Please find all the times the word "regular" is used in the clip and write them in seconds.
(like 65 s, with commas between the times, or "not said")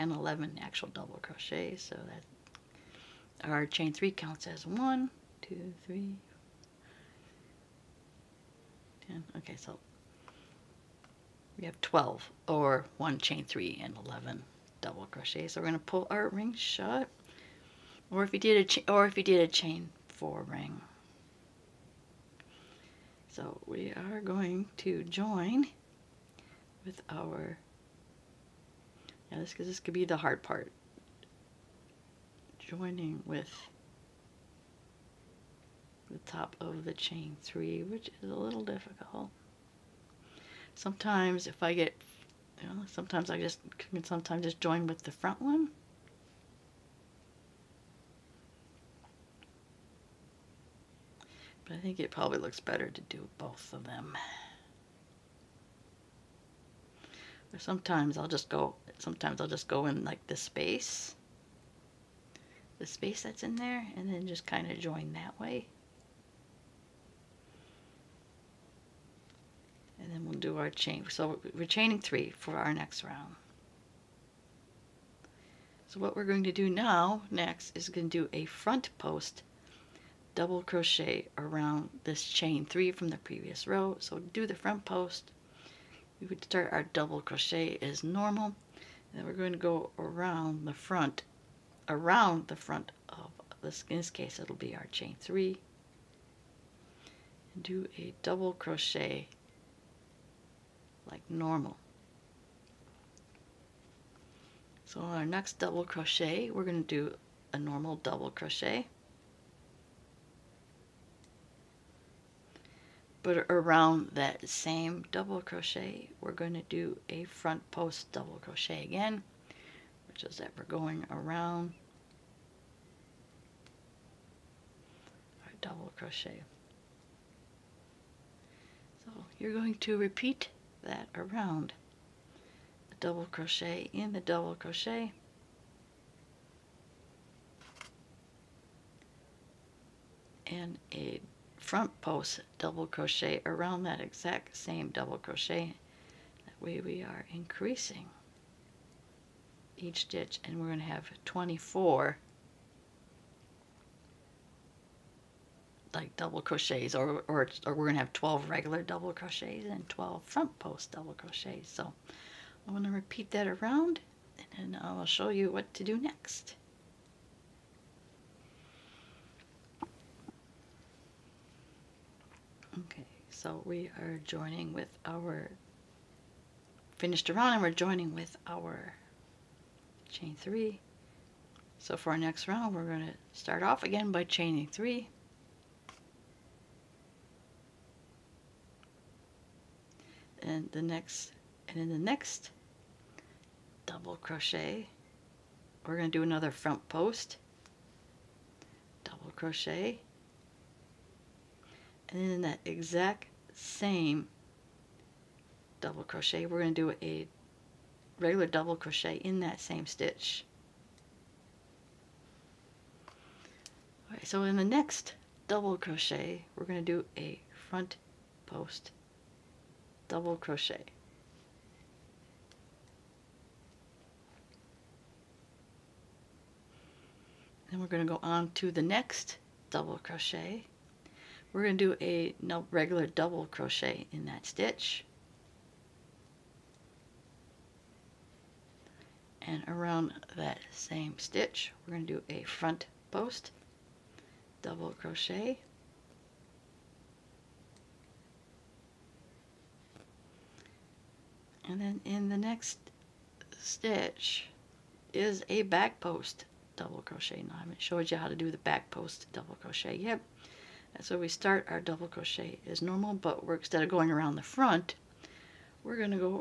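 158 s, 208 s, 232 s.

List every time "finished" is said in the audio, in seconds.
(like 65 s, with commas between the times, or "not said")
176 s.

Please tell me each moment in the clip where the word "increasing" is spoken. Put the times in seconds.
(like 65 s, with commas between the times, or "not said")
147 s.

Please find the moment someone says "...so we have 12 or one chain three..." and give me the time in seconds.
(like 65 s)
9 s.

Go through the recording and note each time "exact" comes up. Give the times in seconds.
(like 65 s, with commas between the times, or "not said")
144 s, 202 s.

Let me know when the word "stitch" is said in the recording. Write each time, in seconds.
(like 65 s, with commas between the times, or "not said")
150 s, 209 s, 234 s, 241 s, 253 s.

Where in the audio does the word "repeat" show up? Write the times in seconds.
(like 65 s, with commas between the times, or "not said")
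129 s, 162 s.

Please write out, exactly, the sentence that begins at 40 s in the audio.
Sometimes if I get, you know, sometimes I just, can sometimes just join with the front one.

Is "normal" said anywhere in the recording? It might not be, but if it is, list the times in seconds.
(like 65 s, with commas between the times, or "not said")
88 s, 101 s, 107 s, 262 s.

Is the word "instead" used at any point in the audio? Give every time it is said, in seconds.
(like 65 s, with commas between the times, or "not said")
263 s.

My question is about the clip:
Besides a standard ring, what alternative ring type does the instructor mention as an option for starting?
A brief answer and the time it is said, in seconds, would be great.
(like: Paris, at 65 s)
chain four ring, at 19 s.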